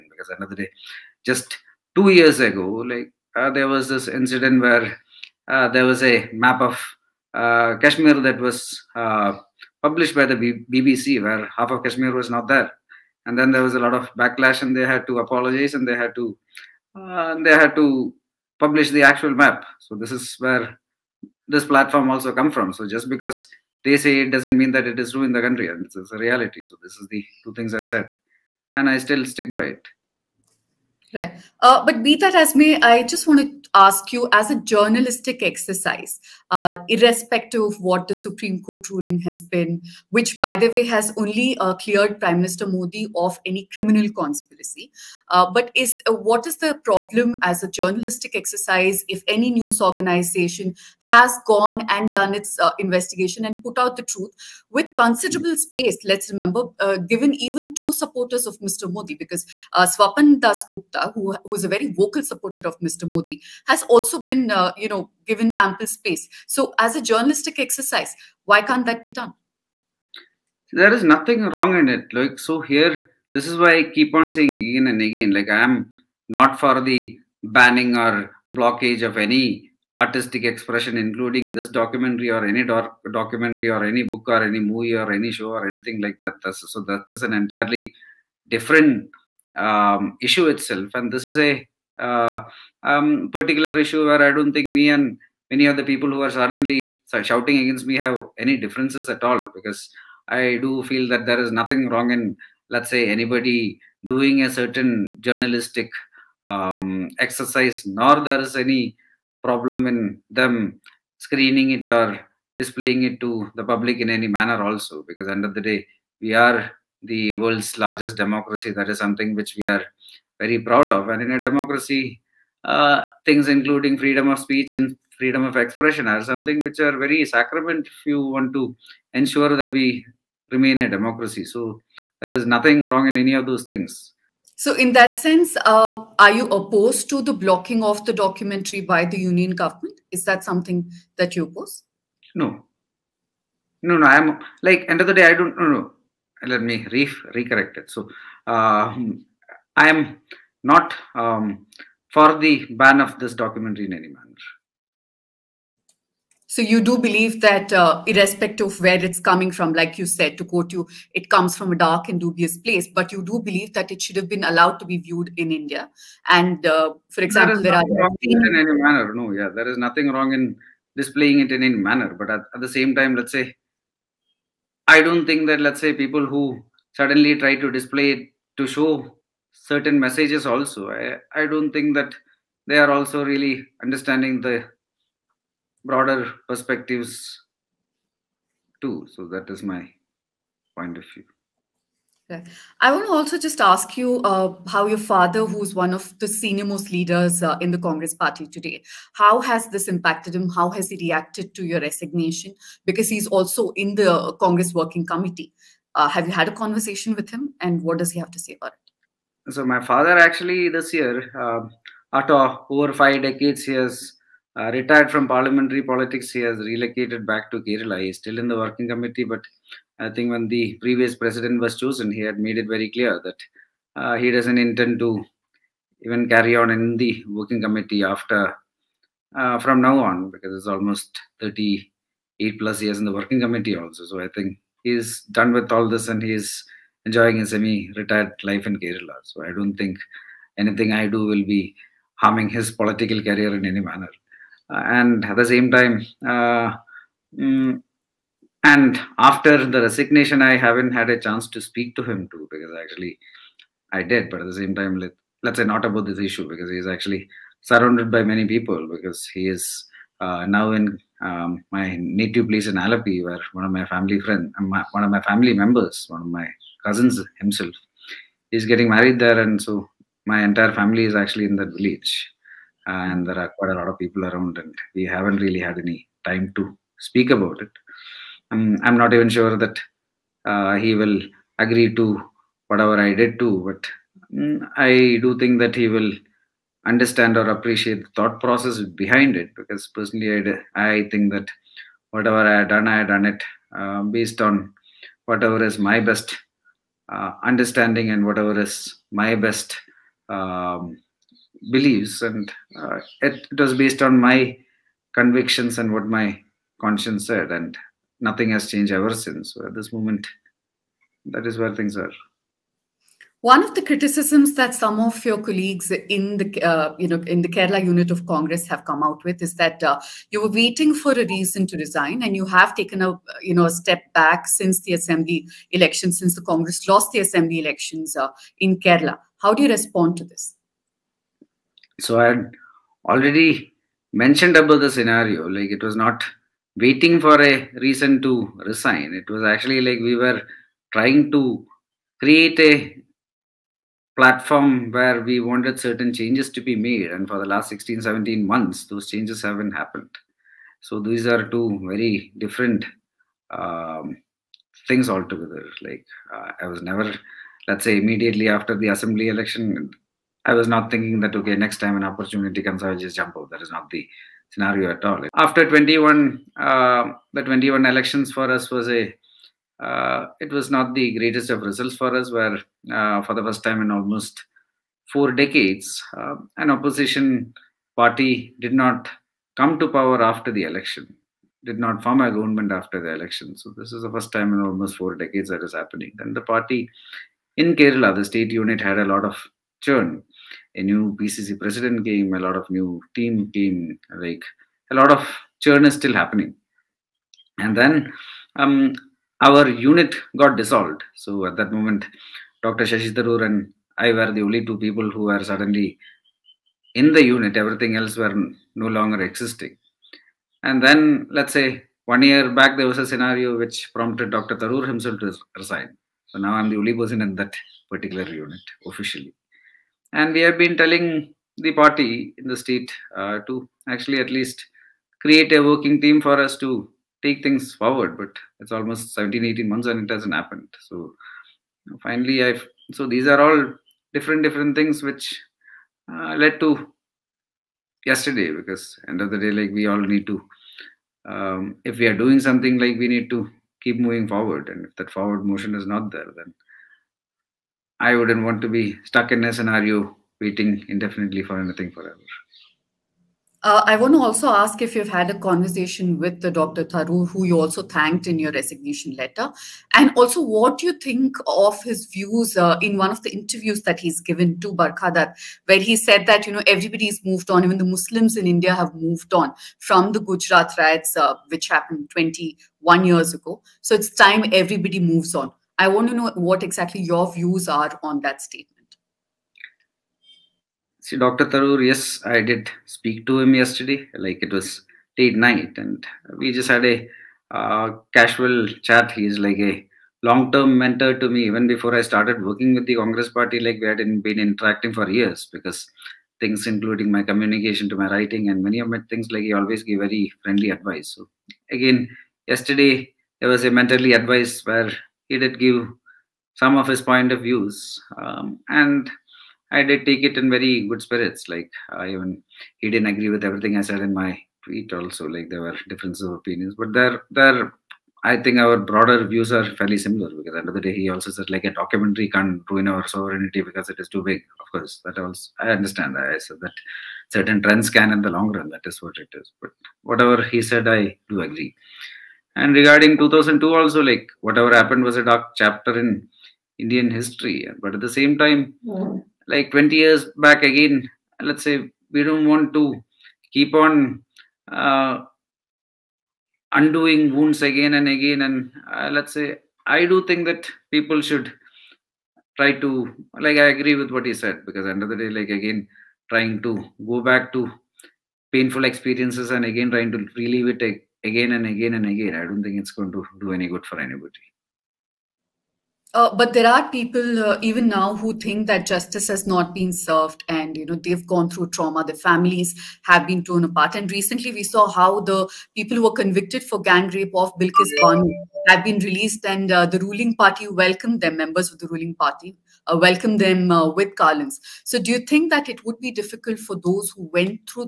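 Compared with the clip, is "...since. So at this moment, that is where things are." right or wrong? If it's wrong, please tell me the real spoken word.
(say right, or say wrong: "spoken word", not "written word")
right.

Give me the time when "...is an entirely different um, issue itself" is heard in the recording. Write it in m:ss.
1:27.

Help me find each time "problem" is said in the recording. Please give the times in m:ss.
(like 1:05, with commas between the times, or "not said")
0:46, 1:49.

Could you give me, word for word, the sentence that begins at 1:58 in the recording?
That is something which we are very proud of.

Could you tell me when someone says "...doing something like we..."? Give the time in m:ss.
7:22.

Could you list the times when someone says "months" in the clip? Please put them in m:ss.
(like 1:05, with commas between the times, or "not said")
5:48, 7:09.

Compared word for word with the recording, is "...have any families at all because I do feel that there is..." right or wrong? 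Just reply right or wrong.
wrong.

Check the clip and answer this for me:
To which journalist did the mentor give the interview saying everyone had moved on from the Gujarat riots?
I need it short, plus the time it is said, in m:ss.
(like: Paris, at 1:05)
Barkha Dutt, at 7:44.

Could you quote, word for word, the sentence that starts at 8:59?
like 20 years back again, let's say we don't want to keep on uh, undoing wounds again and again.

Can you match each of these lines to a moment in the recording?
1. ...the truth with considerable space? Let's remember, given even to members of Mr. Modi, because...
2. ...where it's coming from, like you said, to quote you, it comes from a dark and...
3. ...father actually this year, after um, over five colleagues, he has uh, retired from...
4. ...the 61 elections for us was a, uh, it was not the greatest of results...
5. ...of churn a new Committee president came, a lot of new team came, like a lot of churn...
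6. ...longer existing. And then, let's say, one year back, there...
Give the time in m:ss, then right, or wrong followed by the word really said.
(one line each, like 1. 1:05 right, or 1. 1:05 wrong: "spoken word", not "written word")
1. 0:53 wrong: "supporters", not "members"
2. 2:38 right
3. 3:29 wrong: "decades", not "colleagues"
4. 6:07 wrong: "21", not "61"
5. 6:29 wrong: "PCC", not "Committee"
6. 6:48 right.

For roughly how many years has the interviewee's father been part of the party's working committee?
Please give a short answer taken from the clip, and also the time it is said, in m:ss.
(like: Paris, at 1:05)
38 plus years, at 3:51.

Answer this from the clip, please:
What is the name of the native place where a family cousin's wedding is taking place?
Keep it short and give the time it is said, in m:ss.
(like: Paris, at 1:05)
Alleppey, at 4:22.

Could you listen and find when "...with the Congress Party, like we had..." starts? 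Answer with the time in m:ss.
8:12.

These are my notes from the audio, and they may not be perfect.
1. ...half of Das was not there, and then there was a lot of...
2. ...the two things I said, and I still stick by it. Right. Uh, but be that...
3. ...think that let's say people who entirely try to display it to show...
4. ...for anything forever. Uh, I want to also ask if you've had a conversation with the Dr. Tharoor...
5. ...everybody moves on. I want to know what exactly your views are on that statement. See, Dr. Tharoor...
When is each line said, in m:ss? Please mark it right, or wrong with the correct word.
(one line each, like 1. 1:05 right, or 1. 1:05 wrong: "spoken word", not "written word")
1. 0:11 wrong: "Kashmir", not "Das"
2. 0:27 right
3. 2:55 wrong: "suddenly", not "entirely"
4. 7:31 right
5. 7:54 right.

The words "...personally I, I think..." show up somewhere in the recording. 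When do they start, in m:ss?
4:49.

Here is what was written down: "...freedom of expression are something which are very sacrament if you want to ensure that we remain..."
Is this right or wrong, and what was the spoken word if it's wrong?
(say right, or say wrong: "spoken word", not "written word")
right.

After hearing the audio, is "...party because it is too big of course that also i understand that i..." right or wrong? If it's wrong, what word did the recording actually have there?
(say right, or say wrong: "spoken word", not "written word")
wrong: "sovereignty", not "party".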